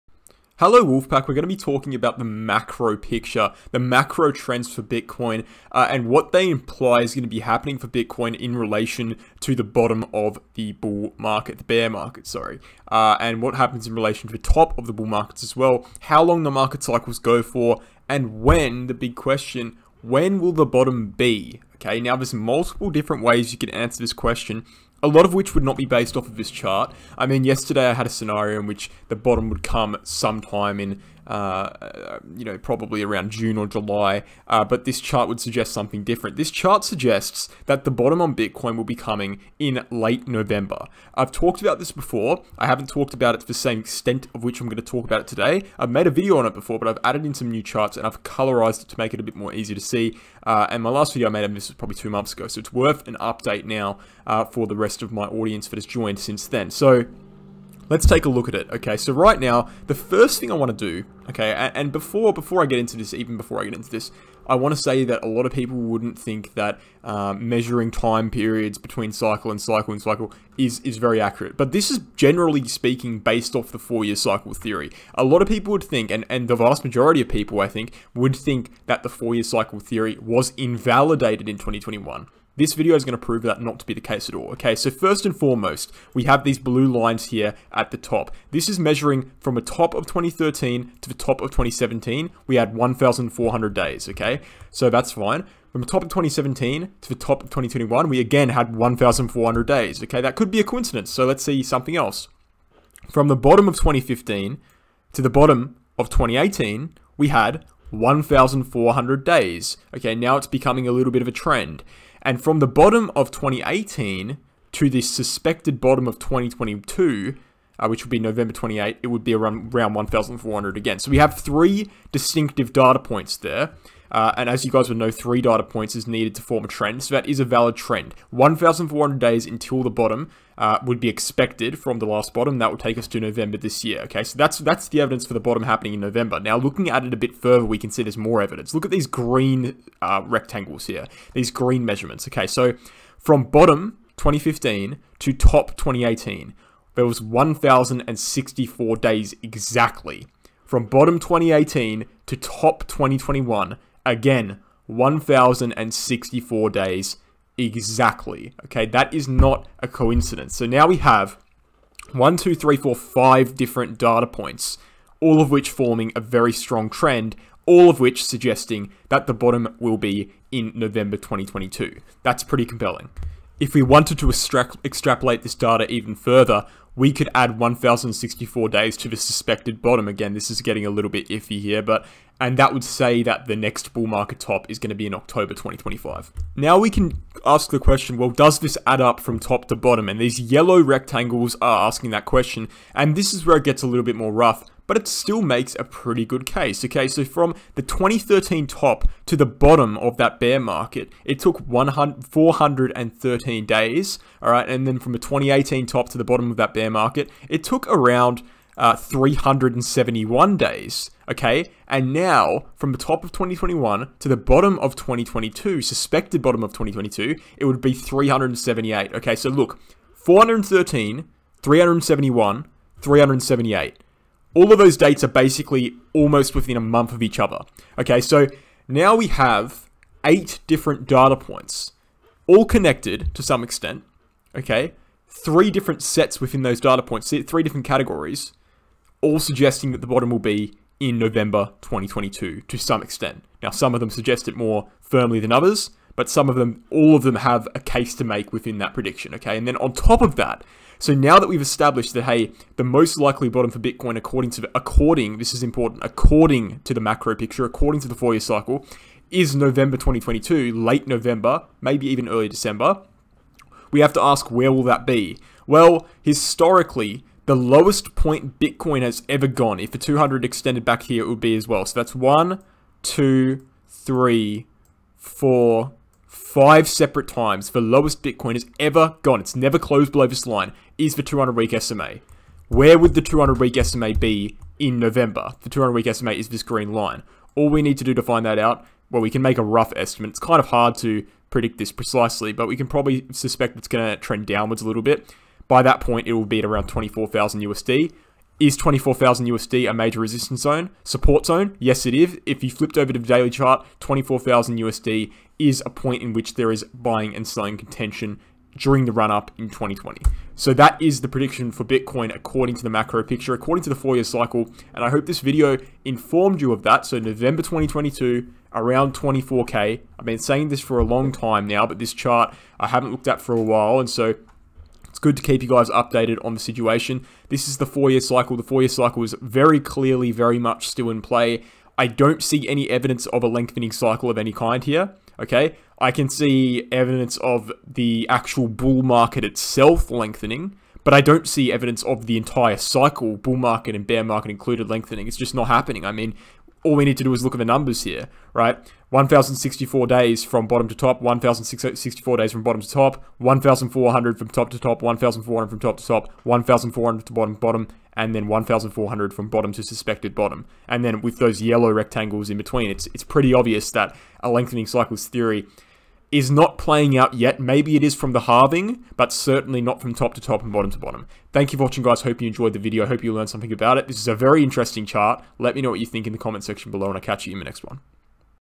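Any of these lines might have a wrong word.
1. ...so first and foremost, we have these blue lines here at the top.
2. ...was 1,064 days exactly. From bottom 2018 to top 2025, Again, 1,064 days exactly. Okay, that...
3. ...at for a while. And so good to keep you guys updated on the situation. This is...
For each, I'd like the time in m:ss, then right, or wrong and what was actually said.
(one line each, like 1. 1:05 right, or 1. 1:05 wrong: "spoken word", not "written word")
1. 1:24 right
2. 2:27 wrong: "2021", not "2025"
3. 5:23 right.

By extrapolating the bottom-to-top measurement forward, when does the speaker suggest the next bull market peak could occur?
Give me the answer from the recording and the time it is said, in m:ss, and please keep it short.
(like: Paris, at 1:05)
October 2025, at 3:05.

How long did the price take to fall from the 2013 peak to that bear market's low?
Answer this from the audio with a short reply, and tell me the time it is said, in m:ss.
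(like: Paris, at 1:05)
413 days, at 3:21.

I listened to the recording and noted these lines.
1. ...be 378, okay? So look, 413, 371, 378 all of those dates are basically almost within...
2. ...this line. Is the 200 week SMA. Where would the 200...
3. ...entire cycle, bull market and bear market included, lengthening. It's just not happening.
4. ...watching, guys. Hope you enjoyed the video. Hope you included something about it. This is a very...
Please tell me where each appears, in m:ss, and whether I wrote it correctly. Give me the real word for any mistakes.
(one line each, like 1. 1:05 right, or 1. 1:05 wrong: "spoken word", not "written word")
1. 3:37 right
2. 4:40 right
3. 5:42 right
4. 6:11 wrong: "learned", not "included".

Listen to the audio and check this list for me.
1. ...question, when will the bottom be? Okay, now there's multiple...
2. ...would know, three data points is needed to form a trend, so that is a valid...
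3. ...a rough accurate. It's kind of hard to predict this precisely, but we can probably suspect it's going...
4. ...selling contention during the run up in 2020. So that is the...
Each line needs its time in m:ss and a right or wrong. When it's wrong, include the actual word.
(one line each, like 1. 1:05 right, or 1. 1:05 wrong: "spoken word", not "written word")
1. 0:19 right
2. 2:04 right
3. 4:49 wrong: "estimate", not "accurate"
4. 5:07 right.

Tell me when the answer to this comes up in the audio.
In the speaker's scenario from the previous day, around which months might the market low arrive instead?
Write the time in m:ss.
0:33.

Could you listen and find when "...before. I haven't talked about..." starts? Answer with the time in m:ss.
0:41.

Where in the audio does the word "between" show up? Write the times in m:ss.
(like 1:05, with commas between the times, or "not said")
1:08, 6:02.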